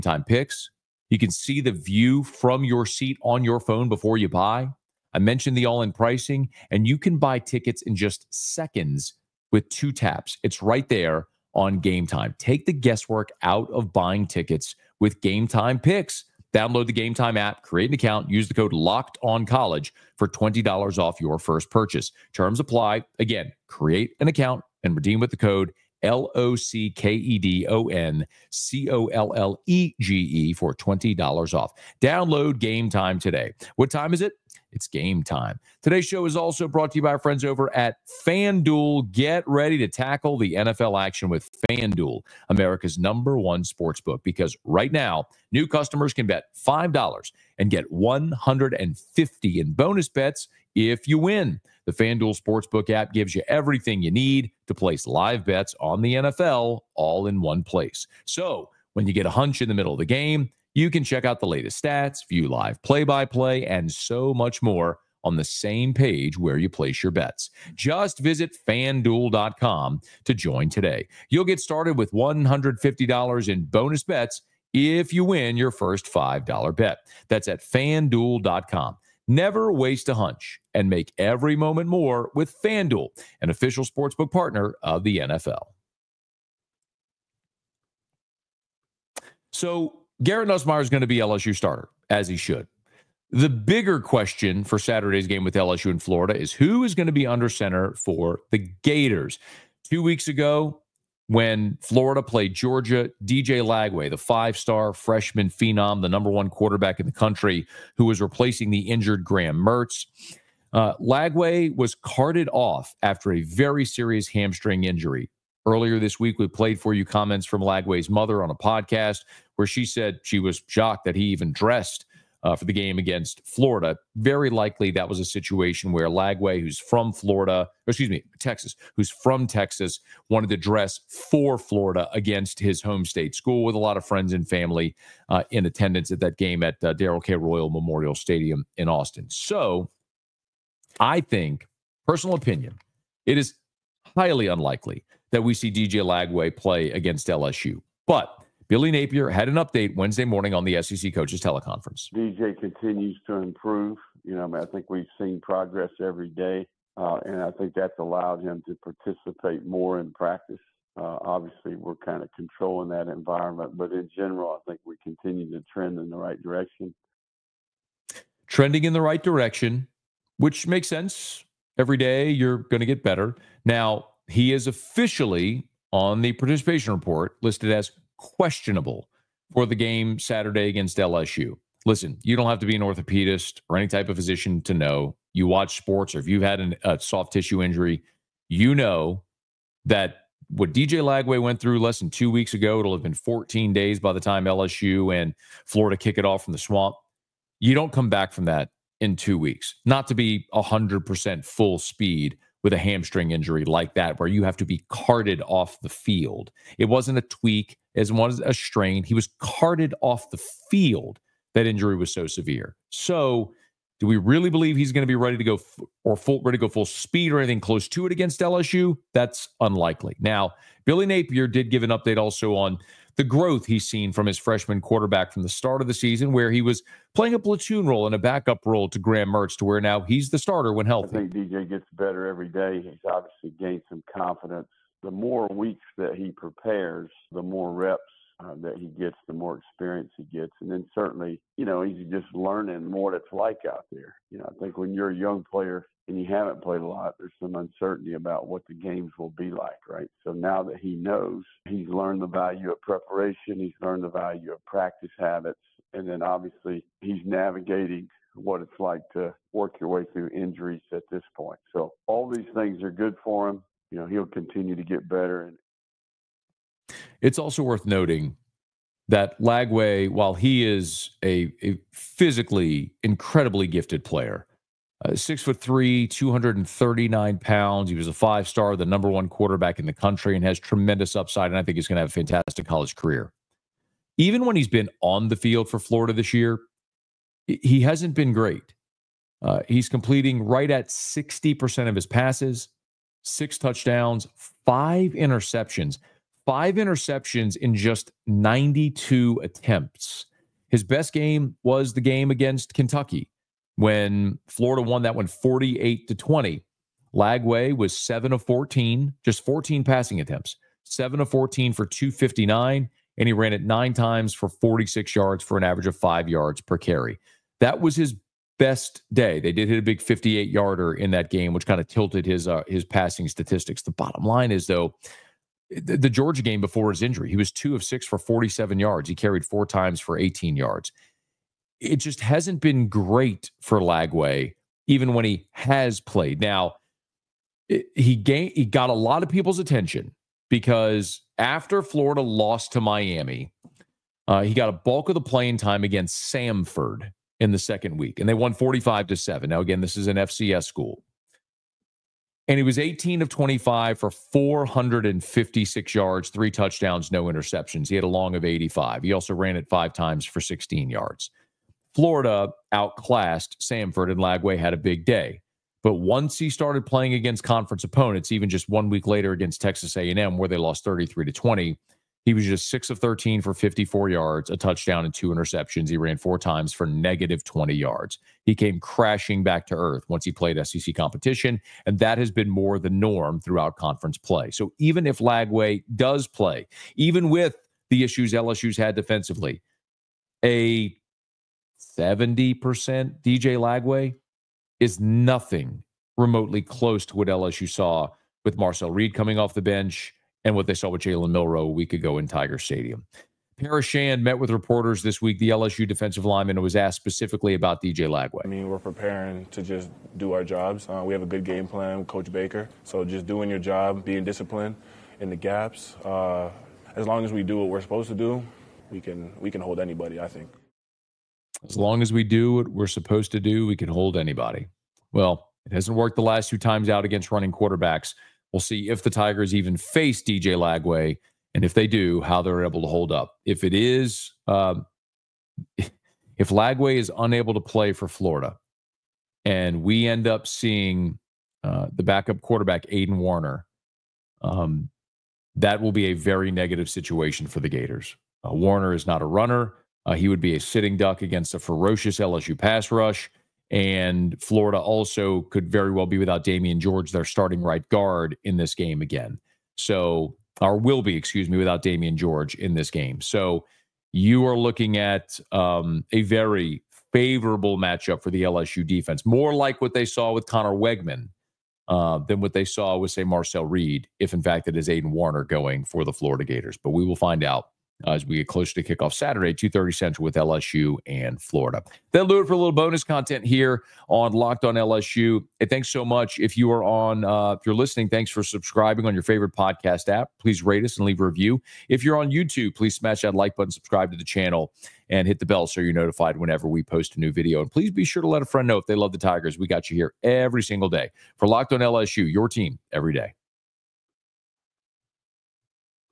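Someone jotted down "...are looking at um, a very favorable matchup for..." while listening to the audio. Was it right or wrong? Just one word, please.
right.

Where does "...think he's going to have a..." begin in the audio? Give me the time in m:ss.
4:41.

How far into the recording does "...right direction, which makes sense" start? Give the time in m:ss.
2:49.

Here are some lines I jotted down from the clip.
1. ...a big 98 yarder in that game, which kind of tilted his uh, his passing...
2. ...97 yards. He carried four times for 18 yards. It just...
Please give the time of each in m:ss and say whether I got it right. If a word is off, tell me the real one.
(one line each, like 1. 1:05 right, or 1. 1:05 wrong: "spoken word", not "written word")
1. 5:19 wrong: "58", not "98"
2. 5:28 wrong: "47", not "97".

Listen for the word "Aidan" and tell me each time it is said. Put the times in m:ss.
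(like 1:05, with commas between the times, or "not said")
7:22, 7:54.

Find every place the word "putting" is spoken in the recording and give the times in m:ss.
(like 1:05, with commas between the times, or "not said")
not said.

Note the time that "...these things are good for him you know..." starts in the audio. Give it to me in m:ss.
4:22.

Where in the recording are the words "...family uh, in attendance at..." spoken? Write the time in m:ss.
2:14.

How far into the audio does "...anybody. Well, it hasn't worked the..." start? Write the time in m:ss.
7:04.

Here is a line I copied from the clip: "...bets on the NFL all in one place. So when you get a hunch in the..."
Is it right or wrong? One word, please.
right.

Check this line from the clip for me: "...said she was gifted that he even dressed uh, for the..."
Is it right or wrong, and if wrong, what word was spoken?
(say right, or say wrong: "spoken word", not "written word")
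wrong: "shocked", not "gifted".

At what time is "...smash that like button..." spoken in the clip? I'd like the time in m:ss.
8:12.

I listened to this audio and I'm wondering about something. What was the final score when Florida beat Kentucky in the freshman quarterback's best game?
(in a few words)
48 to 20.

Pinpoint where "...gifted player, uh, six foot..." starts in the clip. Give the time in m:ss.
4:33.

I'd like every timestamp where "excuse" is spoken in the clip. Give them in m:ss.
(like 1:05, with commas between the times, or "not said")
2:07, 7:41.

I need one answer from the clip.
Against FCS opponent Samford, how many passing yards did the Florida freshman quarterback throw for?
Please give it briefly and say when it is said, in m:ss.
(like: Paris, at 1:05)
456, at 5:54.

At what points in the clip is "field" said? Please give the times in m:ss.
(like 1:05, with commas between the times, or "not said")
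3:25, 3:30, 4:45.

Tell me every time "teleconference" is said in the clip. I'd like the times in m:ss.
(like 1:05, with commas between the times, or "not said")
2:31.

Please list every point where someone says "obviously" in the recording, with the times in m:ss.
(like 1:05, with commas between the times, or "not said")
2:41, 3:53, 4:16.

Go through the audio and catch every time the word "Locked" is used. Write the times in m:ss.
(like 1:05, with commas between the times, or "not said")
0:18, 8:04, 8:21.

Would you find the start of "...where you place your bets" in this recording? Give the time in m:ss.
1:06.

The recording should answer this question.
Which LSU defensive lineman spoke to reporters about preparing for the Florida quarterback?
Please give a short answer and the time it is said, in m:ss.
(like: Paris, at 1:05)
Paris Shand, at 6:43.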